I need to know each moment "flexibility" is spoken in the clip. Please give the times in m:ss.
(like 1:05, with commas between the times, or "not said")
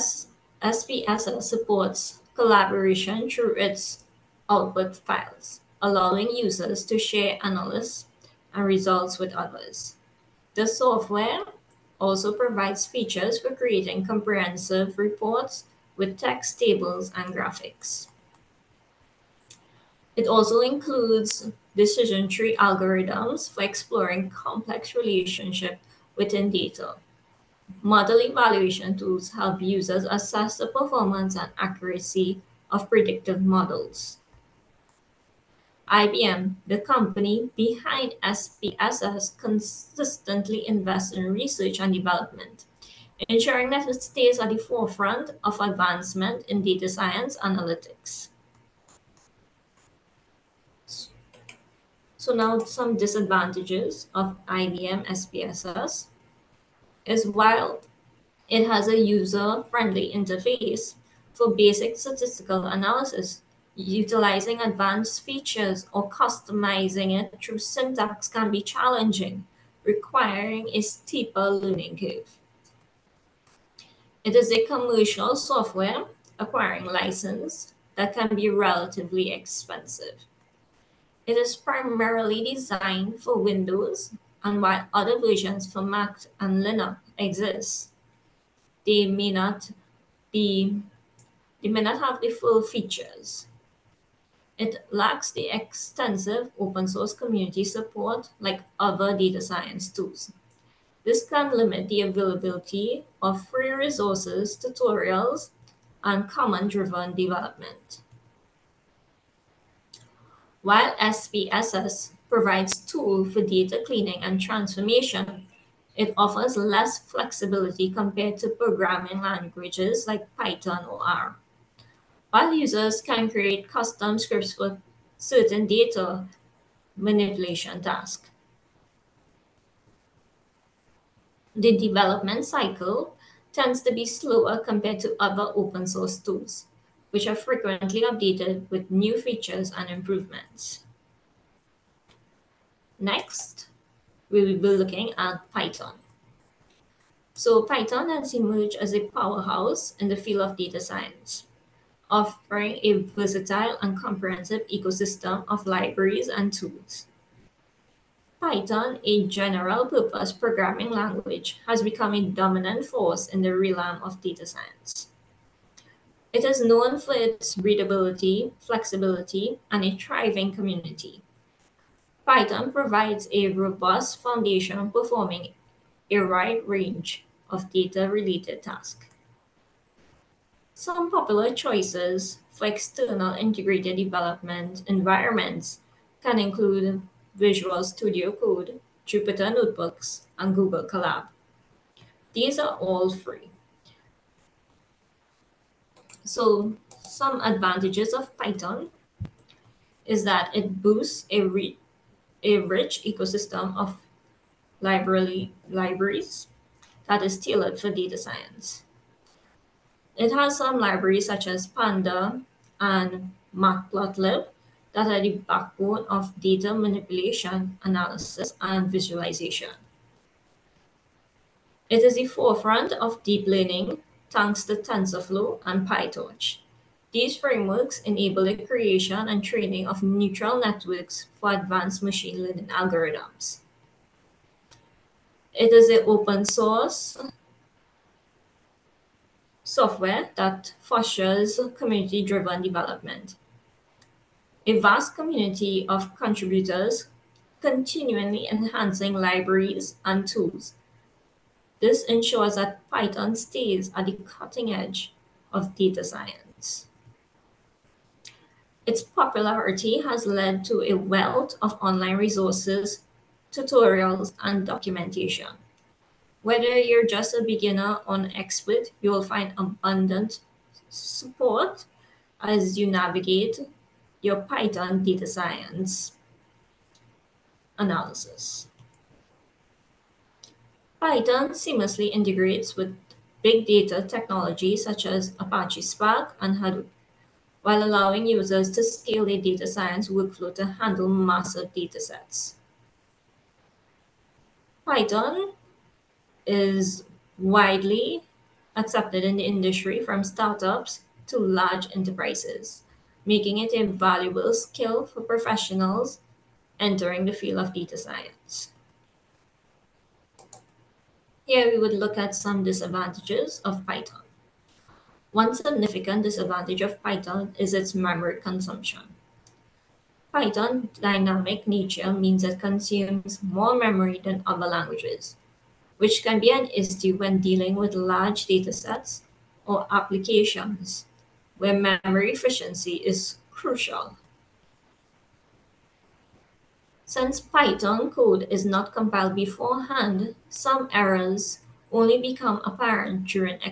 1:56, 2:48.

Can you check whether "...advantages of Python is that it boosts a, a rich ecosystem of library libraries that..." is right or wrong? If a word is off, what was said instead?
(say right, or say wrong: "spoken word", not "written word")
right.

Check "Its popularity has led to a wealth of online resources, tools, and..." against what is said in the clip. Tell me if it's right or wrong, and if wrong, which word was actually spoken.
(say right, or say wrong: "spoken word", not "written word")
wrong: "tutorials", not "tools".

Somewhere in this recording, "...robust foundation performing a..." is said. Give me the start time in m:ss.
2:53.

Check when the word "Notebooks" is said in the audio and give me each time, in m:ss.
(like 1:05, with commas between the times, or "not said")
3:09.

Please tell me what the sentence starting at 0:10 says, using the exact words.
The software also provides features for creating comprehensive reports with text, tables, and graphics.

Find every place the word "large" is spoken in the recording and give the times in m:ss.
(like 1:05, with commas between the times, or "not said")
5:01, 5:27.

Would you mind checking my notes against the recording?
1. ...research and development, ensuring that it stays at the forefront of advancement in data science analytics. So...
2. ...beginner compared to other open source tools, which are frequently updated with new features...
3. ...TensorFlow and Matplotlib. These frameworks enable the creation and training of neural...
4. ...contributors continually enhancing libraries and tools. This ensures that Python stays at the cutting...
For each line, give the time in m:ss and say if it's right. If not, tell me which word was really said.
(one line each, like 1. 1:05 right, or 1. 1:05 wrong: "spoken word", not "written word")
1. 0:41 right
2. 2:14 wrong: "slower", not "beginner"
3. 3:44 wrong: "PyTorch", not "Matplotlib"
4. 4:06 right.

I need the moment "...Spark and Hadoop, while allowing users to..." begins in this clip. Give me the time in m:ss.
4:45.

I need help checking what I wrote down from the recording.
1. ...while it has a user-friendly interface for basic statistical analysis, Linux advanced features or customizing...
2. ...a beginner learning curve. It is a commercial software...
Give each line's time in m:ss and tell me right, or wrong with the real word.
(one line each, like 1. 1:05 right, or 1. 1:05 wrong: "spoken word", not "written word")
1. 0:57 wrong: "Utilizing", not "Linux"
2. 1:10 wrong: "steeper", not "beginner".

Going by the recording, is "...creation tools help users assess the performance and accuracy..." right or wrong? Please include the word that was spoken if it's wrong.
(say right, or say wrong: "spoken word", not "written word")
wrong: "evaluation", not "creation".